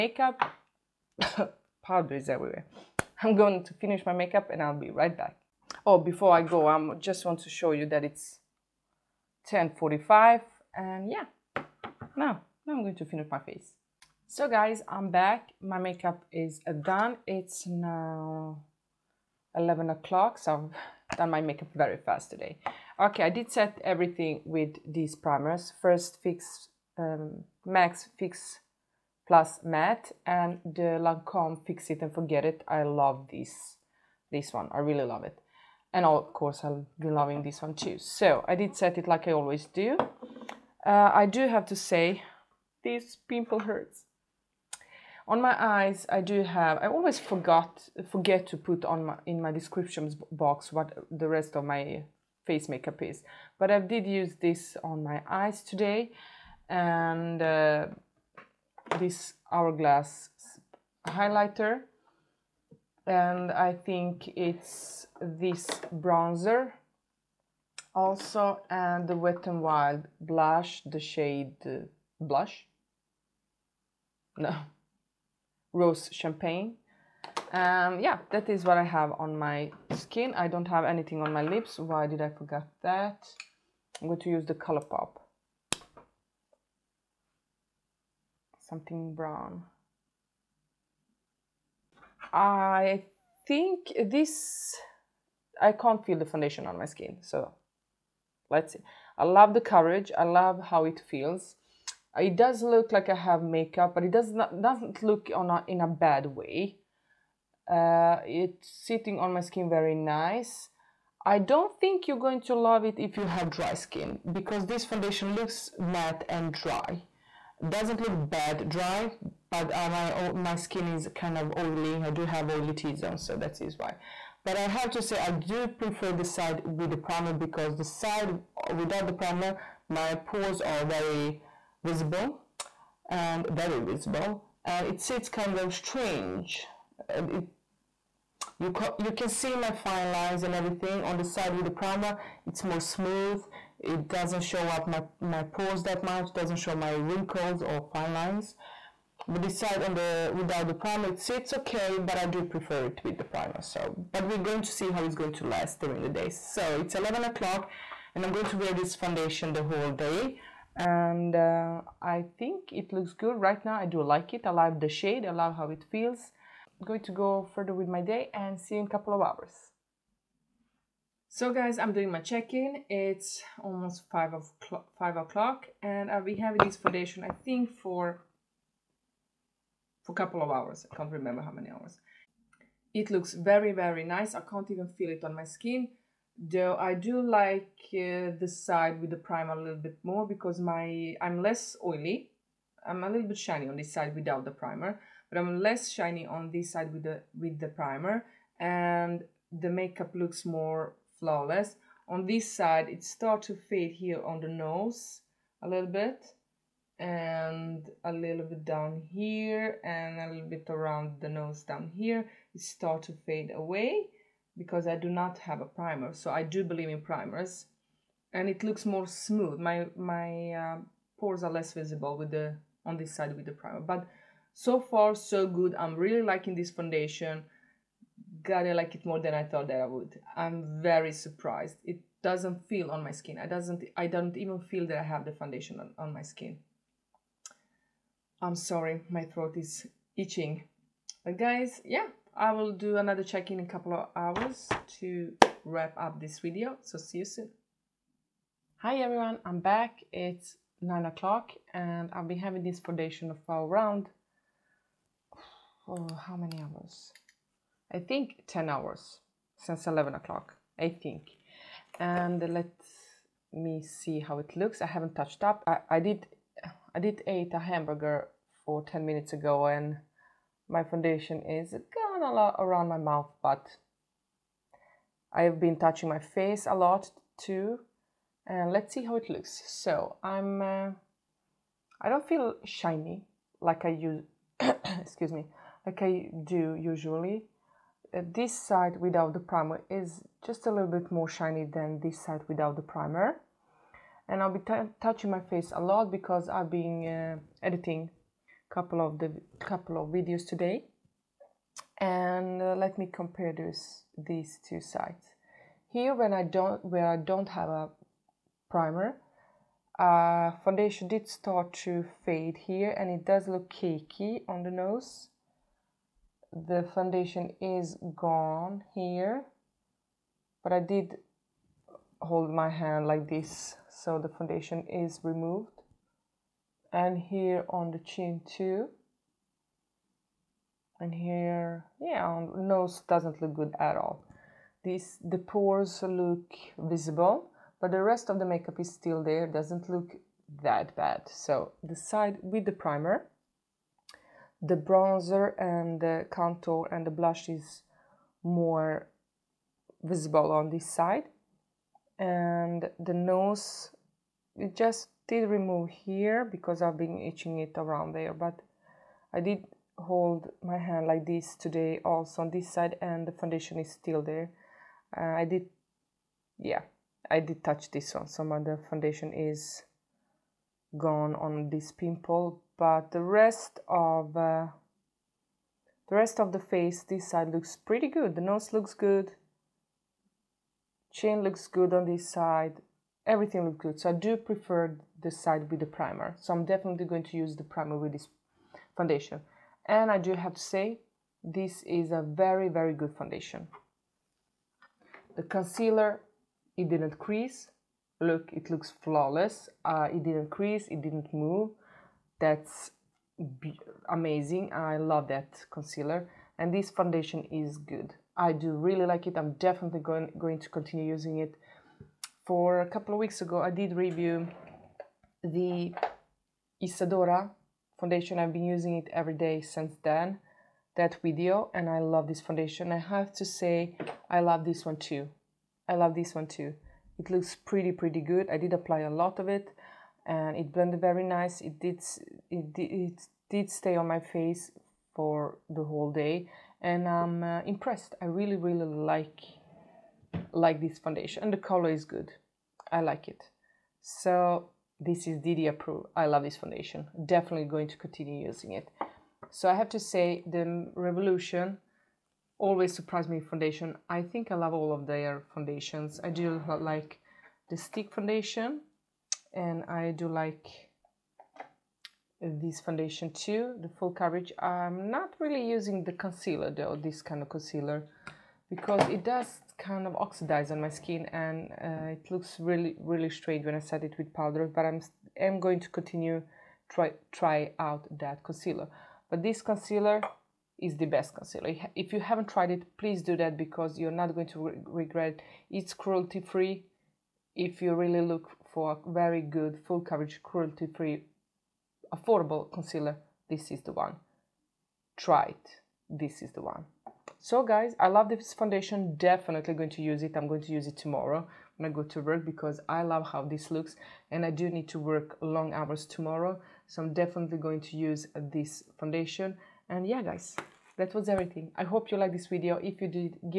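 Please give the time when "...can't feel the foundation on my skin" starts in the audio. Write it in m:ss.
1:35.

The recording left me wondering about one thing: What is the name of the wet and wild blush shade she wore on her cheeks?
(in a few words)
Rose Champagne.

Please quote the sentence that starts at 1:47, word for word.
Uh, it's sitting on my skin very nice.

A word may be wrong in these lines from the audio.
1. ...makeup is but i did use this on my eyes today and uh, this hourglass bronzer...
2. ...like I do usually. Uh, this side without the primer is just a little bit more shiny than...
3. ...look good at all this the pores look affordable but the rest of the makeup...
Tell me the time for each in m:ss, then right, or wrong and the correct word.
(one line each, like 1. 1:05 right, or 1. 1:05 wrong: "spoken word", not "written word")
1. 0:52 wrong: "highlighter", not "bronzer"
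2. 4:45 right
3. 5:33 wrong: "visible", not "affordable".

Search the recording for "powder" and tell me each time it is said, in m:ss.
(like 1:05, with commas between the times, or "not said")
0:01, 7:54.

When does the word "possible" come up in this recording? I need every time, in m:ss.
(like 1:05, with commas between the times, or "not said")
not said.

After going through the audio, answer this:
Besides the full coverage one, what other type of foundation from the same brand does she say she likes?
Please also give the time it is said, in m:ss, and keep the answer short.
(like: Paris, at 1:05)
Stick foundation, at 7:37.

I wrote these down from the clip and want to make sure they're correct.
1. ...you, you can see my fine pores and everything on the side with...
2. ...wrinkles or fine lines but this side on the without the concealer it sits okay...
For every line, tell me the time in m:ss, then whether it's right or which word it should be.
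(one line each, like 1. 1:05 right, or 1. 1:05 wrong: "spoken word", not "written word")
1. 2:18 wrong: "lines", not "pores"
2. 2:27 wrong: "primer", not "concealer".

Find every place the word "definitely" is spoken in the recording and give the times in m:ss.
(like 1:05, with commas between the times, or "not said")
6:26, 6:49, 7:27, 8:19, 8:27.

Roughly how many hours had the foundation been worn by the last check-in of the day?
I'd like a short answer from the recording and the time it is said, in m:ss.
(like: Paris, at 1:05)
10 hours, at 4:18.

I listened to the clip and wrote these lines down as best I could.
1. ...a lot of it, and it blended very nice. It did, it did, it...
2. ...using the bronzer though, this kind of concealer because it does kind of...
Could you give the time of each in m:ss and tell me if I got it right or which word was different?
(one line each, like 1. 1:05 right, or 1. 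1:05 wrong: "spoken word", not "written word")
1. 7:08 right
2. 7:45 wrong: "concealer", not "bronzer".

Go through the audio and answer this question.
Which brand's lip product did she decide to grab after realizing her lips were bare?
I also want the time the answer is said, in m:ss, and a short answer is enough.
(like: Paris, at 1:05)
Color Pop, at 1:24.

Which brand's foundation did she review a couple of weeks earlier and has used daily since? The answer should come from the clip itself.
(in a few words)
Isadora.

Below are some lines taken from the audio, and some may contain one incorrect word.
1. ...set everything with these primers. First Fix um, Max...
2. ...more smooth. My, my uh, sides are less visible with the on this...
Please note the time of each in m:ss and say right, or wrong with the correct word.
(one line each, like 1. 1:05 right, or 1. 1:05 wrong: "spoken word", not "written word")
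1. 0:23 right
2. 3:38 wrong: "pores", not "sides".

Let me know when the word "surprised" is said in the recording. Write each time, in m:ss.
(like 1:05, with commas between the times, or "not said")
3:51, 7:32.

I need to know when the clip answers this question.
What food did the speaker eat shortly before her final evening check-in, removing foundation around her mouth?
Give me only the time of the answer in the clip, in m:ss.
4:27.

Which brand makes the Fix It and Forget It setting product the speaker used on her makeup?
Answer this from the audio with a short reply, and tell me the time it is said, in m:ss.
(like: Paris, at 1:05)
Lancome, at 0:30.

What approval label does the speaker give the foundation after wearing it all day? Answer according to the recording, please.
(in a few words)
DD approved.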